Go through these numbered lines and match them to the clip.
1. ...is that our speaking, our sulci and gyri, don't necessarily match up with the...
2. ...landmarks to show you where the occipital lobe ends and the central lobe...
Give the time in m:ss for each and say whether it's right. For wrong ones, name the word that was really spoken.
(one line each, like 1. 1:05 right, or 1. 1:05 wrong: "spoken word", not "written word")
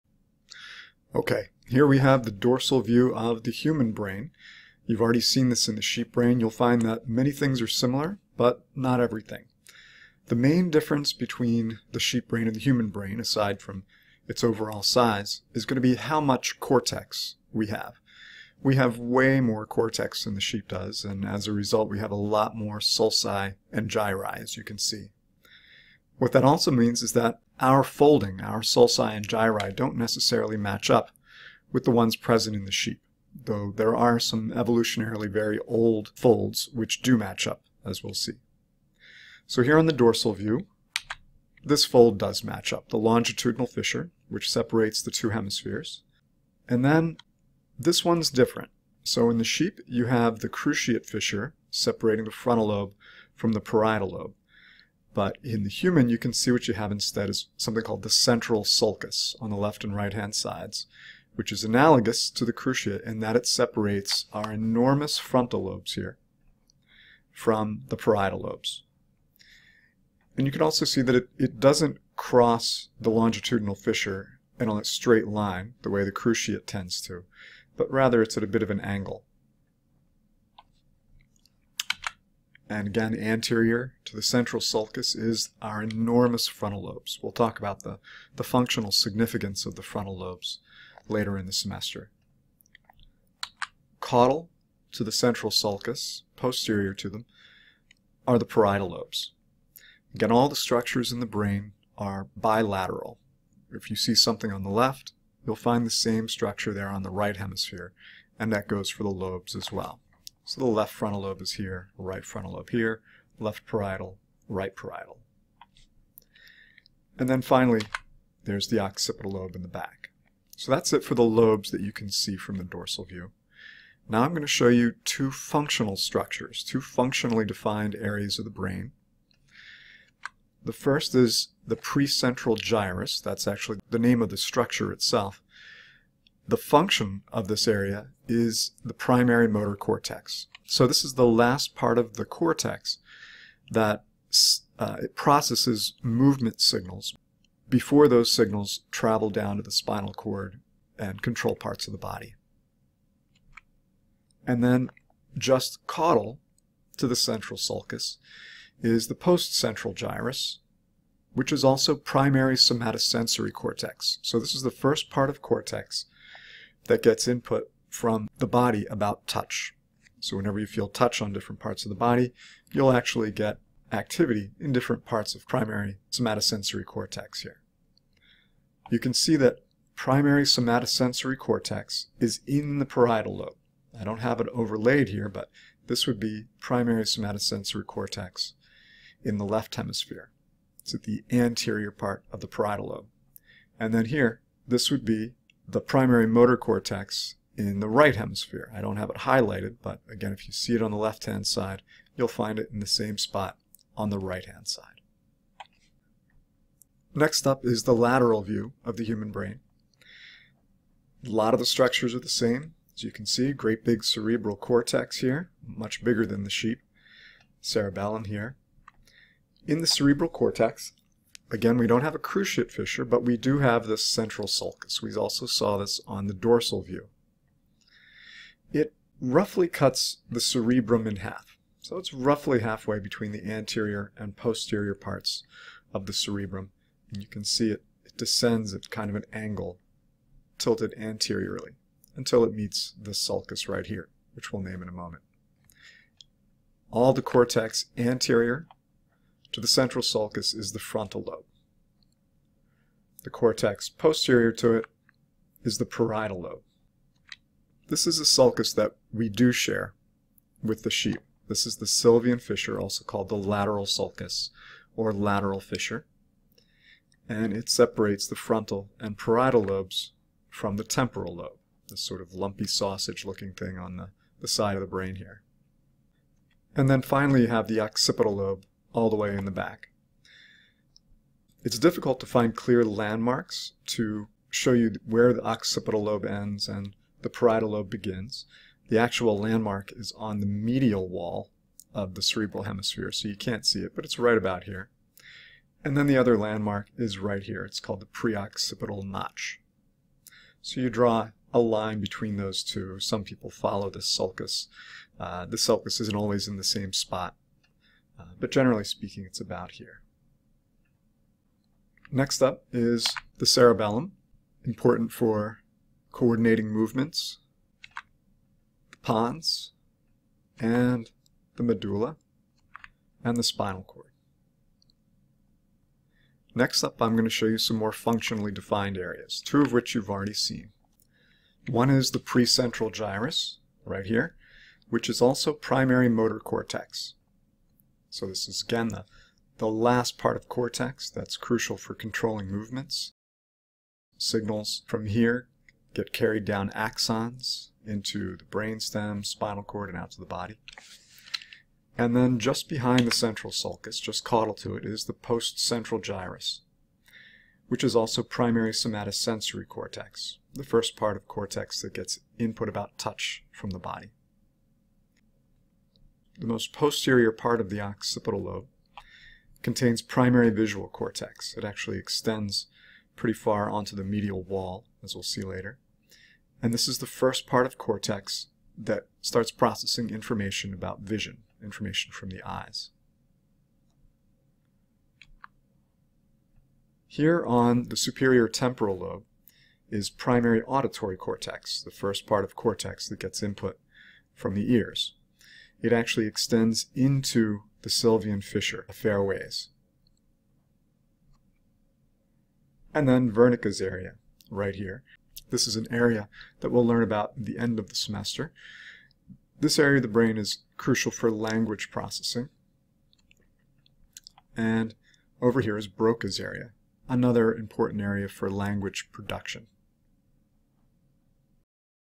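1. 0:27 wrong: "folding", not "speaking"
2. 4:42 wrong: "parietal", not "central".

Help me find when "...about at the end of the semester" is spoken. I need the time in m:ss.
6:47.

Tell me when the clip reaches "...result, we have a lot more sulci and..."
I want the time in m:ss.
0:21.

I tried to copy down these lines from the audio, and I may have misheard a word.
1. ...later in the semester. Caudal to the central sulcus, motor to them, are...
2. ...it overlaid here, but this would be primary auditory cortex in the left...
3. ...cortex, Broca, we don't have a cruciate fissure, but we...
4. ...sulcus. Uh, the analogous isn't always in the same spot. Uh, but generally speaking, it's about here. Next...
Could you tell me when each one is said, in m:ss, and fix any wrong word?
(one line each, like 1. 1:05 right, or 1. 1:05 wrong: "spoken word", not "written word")
1. 1:31 wrong: "posterior", not "motor"
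2. 3:04 wrong: "somatosensory", not "auditory"
3. 3:40 wrong: "Again", not "Broca"
4. 5:04 wrong: "sulcus", not "analogous".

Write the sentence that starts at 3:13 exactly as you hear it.
And then here, this would be the primary motor cortex in the right hemisphere.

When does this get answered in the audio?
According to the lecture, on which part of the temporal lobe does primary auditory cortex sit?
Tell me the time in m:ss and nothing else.
6:27.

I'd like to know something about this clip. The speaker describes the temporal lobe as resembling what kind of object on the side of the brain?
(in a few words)
lumpy sausage.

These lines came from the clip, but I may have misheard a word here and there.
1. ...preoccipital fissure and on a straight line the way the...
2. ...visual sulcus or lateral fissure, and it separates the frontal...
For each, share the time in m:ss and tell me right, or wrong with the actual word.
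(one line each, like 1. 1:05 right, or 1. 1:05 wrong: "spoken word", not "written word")
1. 1:13 wrong: "longitudinal", not "preoccipital"
2. 4:23 wrong: "lateral", not "visual".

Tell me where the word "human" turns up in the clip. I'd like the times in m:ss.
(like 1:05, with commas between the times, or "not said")
0:03, 0:12, 0:55, 3:29.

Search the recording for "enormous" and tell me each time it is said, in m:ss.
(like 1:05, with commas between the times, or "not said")
1:04, 1:25.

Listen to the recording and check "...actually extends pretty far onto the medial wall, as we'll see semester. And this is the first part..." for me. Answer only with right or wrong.
wrong.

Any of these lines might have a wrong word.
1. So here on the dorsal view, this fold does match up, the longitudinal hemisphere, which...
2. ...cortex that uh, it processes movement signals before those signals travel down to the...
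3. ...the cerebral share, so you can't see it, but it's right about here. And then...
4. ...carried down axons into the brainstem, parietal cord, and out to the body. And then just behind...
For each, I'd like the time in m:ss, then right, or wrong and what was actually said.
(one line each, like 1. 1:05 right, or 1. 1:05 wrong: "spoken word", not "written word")
1. 0:39 wrong: "fissure", not "hemisphere"
2. 2:22 right
3. 4:52 wrong: "hemisphere", not "share"
4. 5:46 wrong: "spinal", not "parietal".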